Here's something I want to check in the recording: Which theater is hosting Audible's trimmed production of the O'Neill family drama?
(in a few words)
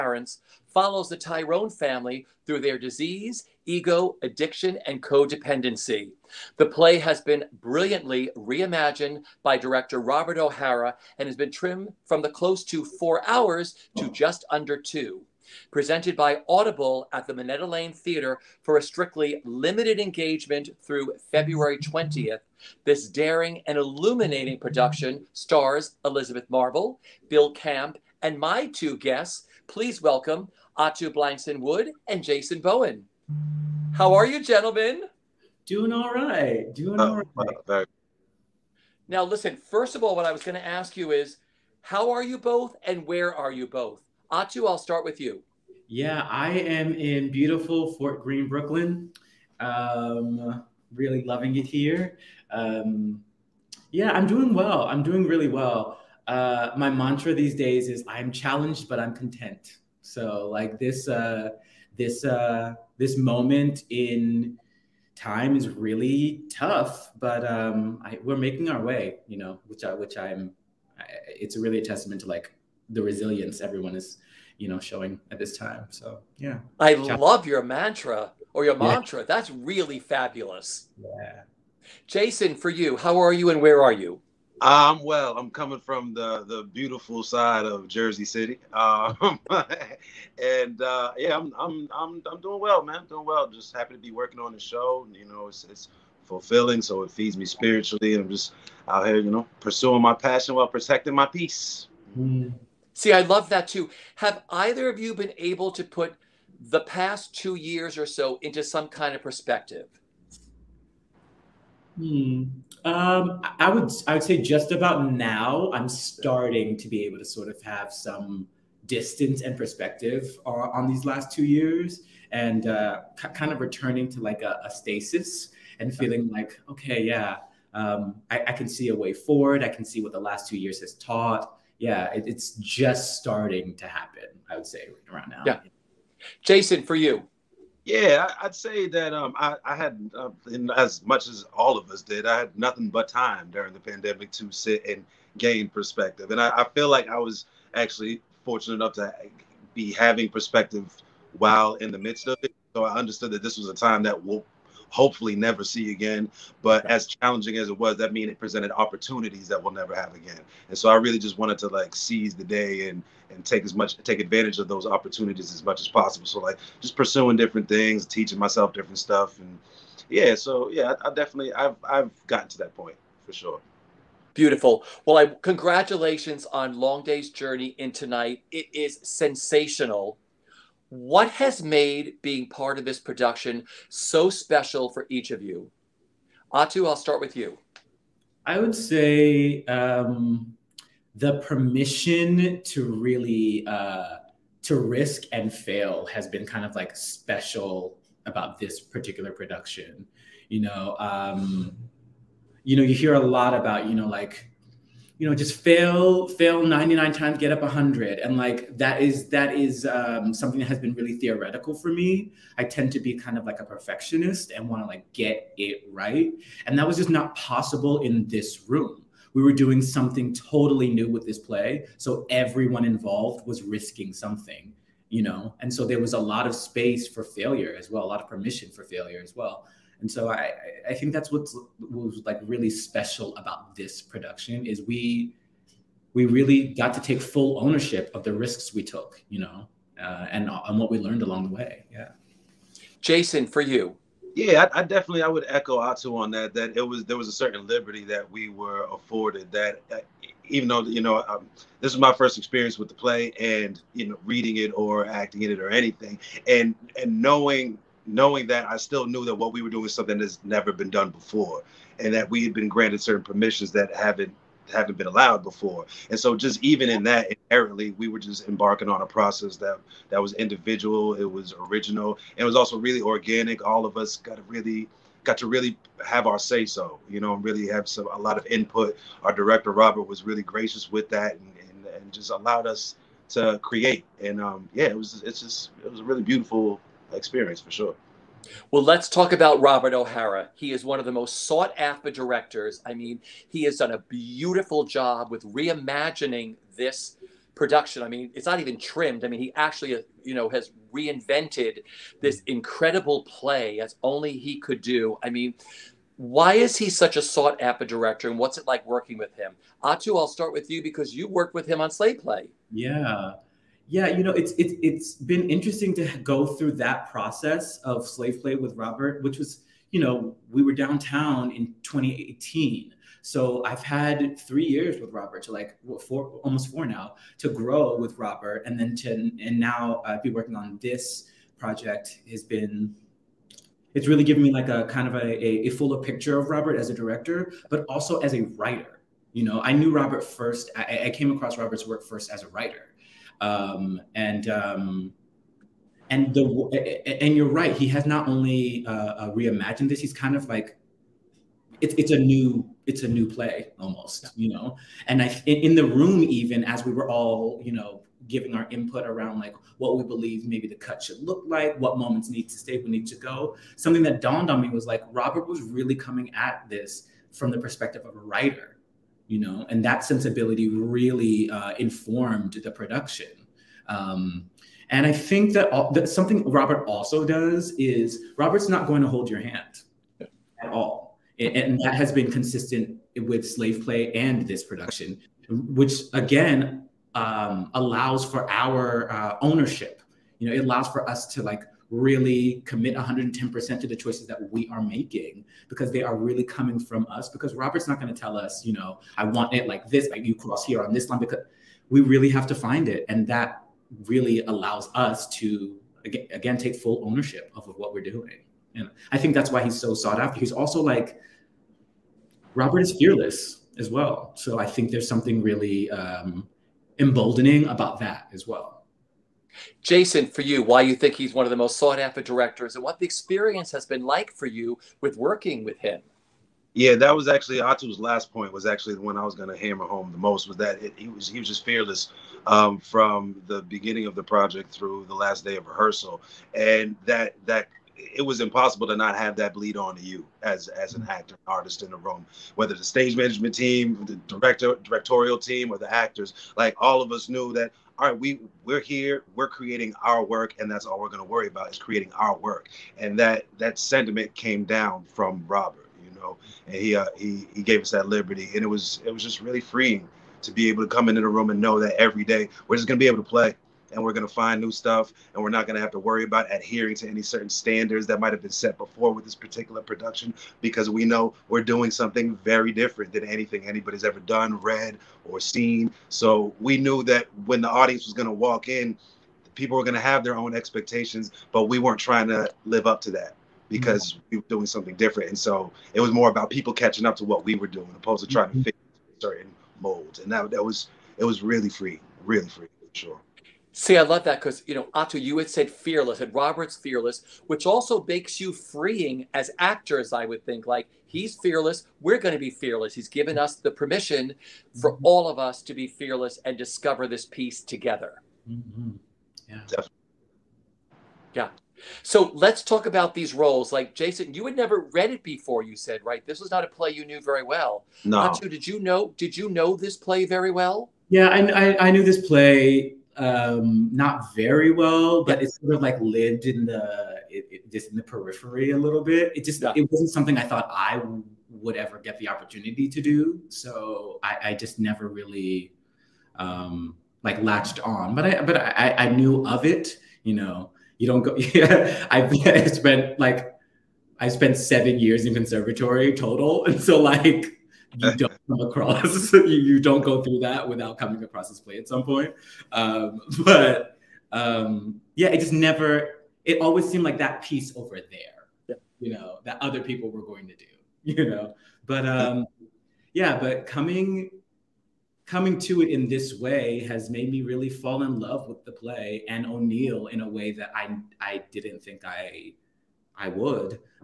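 Minetta Lane Theater.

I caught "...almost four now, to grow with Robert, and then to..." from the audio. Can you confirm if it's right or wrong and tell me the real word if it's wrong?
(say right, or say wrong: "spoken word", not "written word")
right.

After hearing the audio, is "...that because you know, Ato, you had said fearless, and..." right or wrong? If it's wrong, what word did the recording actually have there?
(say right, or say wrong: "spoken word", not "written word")
right.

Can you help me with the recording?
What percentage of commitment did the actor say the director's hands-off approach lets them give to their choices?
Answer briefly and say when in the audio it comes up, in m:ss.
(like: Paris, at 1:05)
110%, at 6:32.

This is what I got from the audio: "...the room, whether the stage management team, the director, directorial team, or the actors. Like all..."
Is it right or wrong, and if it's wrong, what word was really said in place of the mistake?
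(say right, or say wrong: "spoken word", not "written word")
right.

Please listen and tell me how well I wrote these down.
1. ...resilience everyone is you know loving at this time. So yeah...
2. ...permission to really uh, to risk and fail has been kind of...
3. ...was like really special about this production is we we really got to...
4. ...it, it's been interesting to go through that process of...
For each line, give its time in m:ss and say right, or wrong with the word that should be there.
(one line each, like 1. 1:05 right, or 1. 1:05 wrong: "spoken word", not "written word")
1. 1:13 wrong: "showing", not "loving"
2. 3:11 right
3. 3:51 right
4. 5:14 right.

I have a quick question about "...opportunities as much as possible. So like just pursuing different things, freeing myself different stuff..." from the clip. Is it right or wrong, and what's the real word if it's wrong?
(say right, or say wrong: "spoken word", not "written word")
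wrong: "teaching", not "freeing".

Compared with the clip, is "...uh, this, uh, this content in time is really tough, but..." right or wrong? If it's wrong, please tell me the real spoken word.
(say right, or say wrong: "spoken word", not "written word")
wrong: "moment", not "content".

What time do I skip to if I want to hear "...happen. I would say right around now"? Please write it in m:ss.
2:13.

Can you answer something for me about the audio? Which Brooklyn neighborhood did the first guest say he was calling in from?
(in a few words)
Fort Greene.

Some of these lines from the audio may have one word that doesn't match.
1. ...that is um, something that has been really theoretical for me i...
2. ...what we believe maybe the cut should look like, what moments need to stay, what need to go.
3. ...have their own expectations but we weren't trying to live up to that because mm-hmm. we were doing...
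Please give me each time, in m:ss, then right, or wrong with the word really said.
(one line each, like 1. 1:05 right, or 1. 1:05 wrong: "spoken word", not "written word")
1. 3:29 right
2. 5:59 right
3. 7:59 right.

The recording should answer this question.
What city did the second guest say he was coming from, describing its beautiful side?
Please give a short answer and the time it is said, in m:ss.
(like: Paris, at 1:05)
Jersey City, at 1:27.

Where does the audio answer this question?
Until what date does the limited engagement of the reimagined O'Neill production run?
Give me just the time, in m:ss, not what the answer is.
0:21.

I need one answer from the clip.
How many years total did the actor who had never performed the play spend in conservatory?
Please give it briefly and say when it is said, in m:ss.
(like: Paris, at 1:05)
7, at 9:04.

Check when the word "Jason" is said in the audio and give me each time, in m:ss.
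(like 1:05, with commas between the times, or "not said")
0:32, 1:22, 2:16, 4:02, 6:59, 8:33.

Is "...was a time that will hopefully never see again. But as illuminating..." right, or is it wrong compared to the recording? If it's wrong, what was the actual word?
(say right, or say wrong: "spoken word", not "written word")
wrong: "challenging", not "illuminating".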